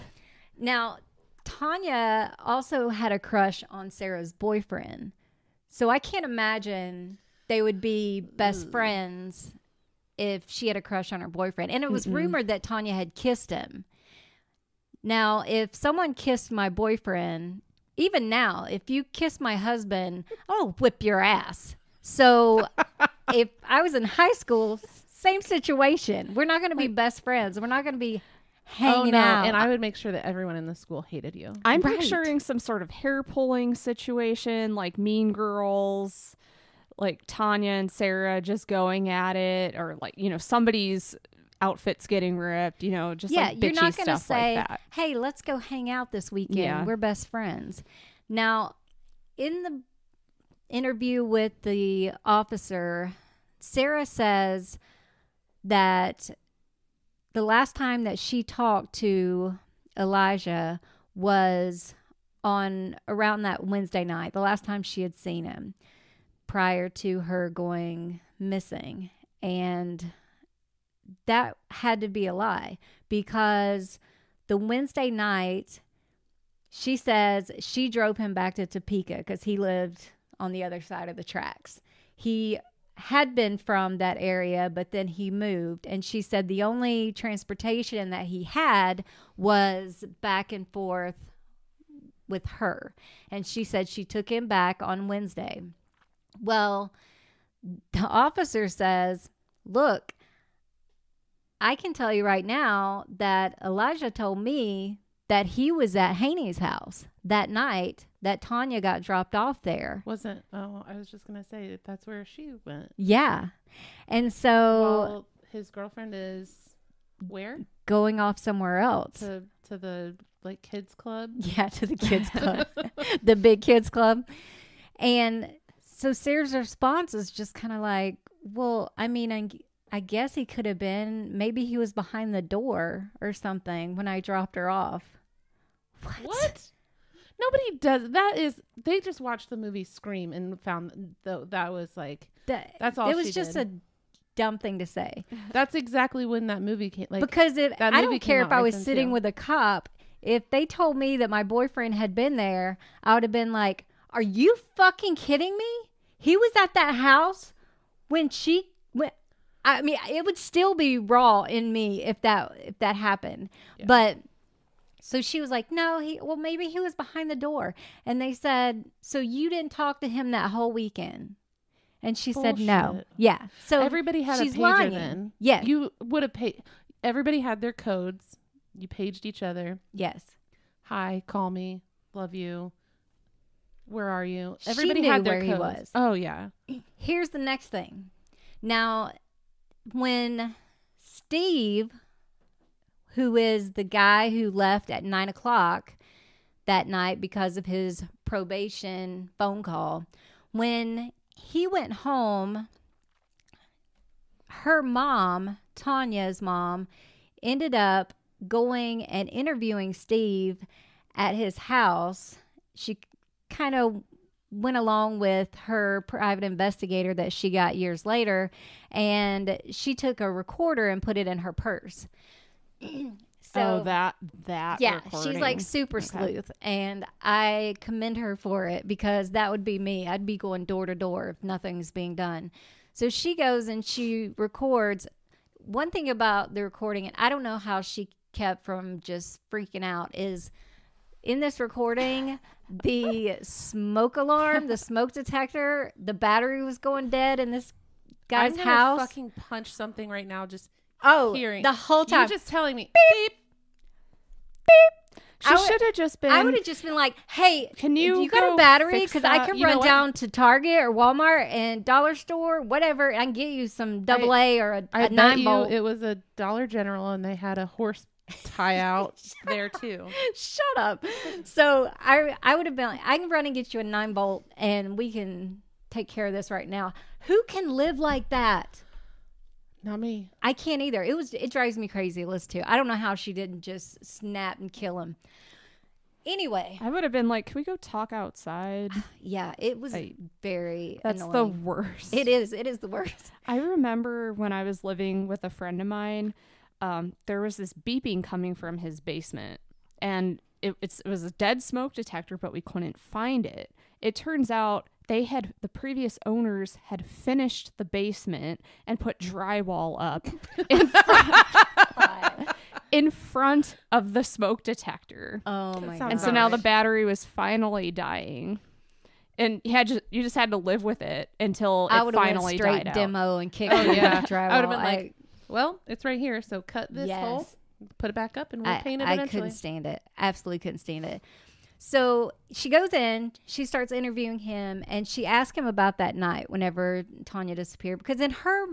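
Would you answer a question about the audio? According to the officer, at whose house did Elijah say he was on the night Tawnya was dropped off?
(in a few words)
Haney's house.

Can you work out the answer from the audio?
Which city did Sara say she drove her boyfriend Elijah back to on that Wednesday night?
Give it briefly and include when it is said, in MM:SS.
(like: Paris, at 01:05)
Topeka, at 01:18.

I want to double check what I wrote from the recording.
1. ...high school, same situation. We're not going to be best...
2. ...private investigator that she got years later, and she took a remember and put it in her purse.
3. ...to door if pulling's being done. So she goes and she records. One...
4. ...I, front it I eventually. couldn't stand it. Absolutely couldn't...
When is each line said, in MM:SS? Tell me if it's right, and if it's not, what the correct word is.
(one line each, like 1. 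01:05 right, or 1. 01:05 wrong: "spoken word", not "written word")
1. 00:24 right
2. 03:36 wrong: "recorder", not "remember"
3. 03:50 wrong: "nothing", not "pulling"
4. 05:28 wrong: "paint", not "front".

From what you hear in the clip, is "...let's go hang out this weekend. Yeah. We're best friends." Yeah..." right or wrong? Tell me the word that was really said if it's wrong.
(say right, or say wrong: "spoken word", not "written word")
wrong: "Now", not "Yeah".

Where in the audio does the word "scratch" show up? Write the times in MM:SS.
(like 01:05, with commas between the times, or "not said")
not said.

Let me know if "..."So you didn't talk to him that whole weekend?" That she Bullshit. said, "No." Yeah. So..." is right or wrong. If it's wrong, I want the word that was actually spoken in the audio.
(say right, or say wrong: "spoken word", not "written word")
wrong: "And", not "That".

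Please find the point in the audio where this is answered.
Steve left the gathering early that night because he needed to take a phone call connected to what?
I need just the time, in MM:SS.
03:18.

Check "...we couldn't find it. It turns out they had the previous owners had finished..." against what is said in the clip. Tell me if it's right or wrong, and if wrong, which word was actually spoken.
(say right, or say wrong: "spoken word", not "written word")
right.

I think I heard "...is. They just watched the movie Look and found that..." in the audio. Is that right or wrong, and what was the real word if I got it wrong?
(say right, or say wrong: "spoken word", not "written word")
wrong: "Scream", not "Look".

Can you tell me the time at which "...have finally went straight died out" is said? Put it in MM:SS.
05:22.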